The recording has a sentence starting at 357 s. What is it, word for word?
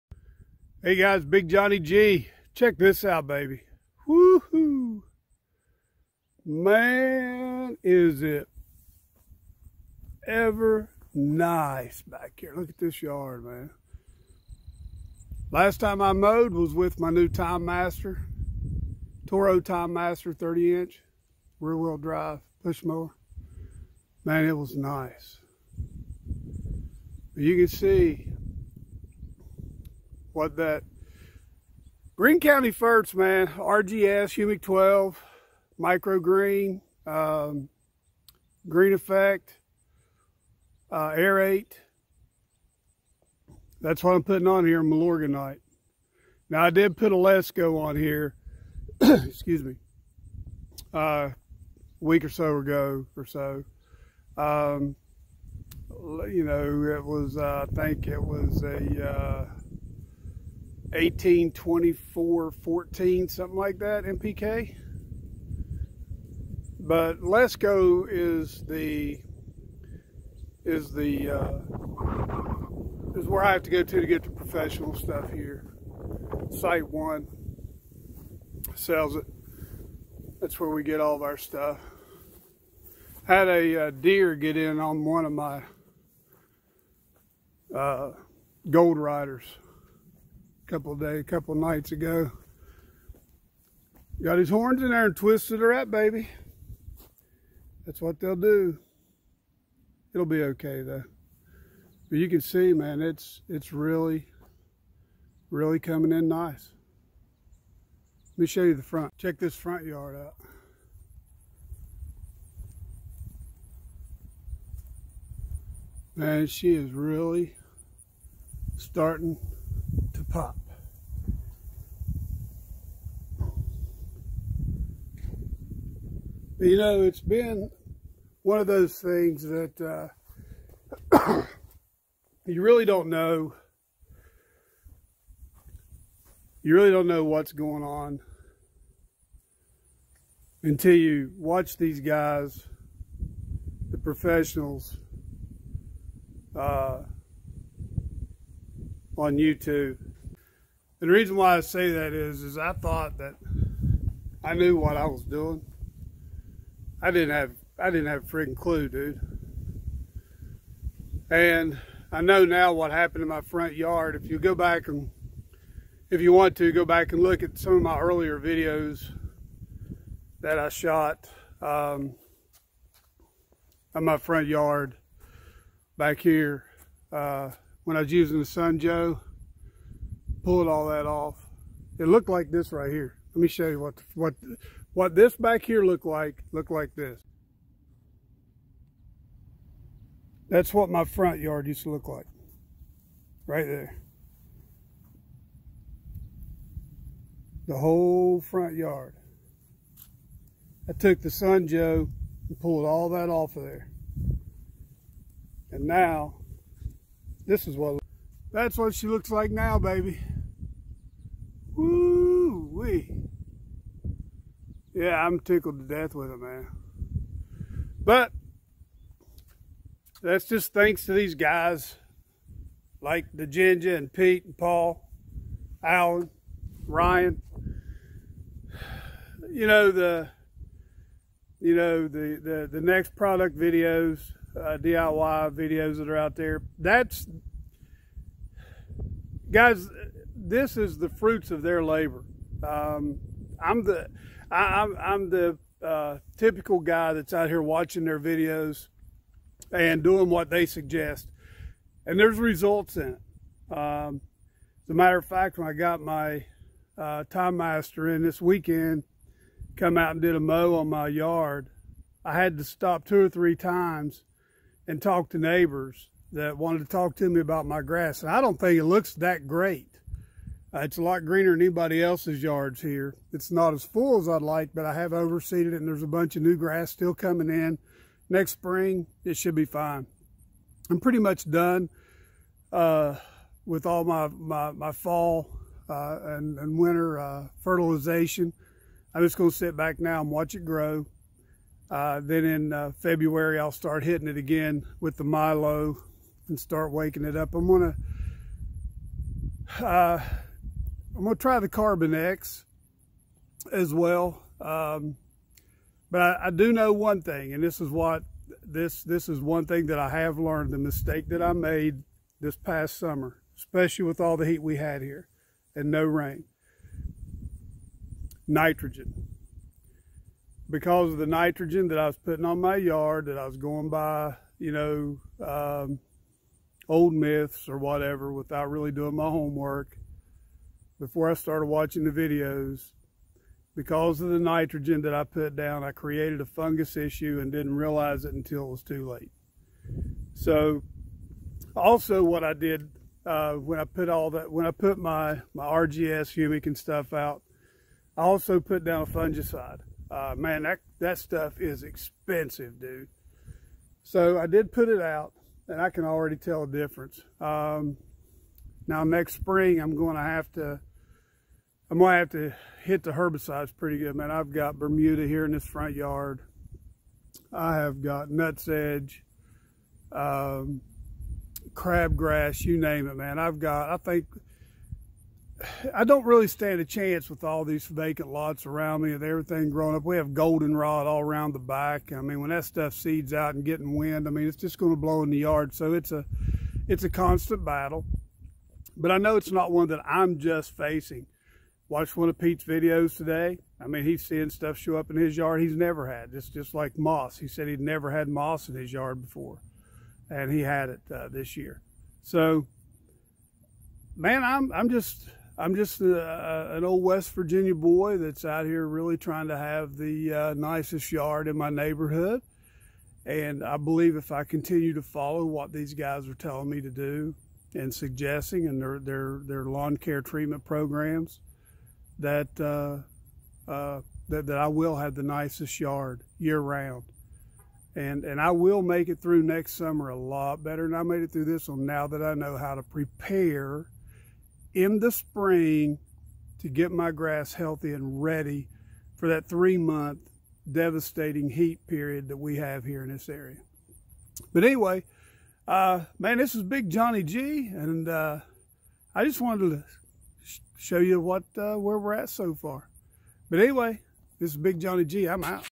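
Um, now next spring, I'm going to have to, I'm going to have to hit the herbicides pretty good, man.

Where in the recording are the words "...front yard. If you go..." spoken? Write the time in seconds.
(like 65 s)
163 s.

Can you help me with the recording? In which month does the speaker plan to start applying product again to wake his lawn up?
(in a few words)
February.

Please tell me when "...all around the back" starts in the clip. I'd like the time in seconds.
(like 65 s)
381 s.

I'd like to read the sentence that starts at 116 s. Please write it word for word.
Man, she is really starting pop.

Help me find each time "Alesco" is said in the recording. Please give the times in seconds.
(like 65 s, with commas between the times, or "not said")
47 s.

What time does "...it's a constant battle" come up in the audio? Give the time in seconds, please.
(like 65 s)
386 s.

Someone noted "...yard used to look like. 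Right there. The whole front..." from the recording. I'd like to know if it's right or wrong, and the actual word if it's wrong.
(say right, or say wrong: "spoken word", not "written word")
right.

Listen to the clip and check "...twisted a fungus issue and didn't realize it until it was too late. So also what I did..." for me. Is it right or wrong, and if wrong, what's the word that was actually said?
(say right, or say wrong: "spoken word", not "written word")
wrong: "created", not "twisted".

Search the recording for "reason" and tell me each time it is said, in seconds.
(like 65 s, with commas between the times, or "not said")
151 s.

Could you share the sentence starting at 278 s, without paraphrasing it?
Next spring, it should be fine.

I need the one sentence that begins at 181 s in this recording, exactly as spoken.
It looked like this right here.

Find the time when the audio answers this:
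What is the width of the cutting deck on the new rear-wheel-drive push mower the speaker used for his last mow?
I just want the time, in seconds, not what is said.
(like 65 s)
20 s.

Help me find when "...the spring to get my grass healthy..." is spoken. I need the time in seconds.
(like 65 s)
434 s.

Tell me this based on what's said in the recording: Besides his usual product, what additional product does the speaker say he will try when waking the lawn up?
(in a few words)
Carbon X.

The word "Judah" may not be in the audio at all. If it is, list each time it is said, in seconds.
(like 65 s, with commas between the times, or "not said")
not said.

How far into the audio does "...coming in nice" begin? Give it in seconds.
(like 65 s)
105 s.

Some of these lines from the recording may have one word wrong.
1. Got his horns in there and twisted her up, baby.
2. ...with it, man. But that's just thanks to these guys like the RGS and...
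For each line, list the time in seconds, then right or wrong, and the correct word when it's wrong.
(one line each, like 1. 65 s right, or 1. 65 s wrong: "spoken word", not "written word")
1. 94 s right
2. 216 s wrong: "Ginger", not "RGS".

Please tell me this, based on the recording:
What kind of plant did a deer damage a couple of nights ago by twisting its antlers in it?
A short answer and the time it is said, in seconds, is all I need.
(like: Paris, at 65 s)
gold riders, at 88 s.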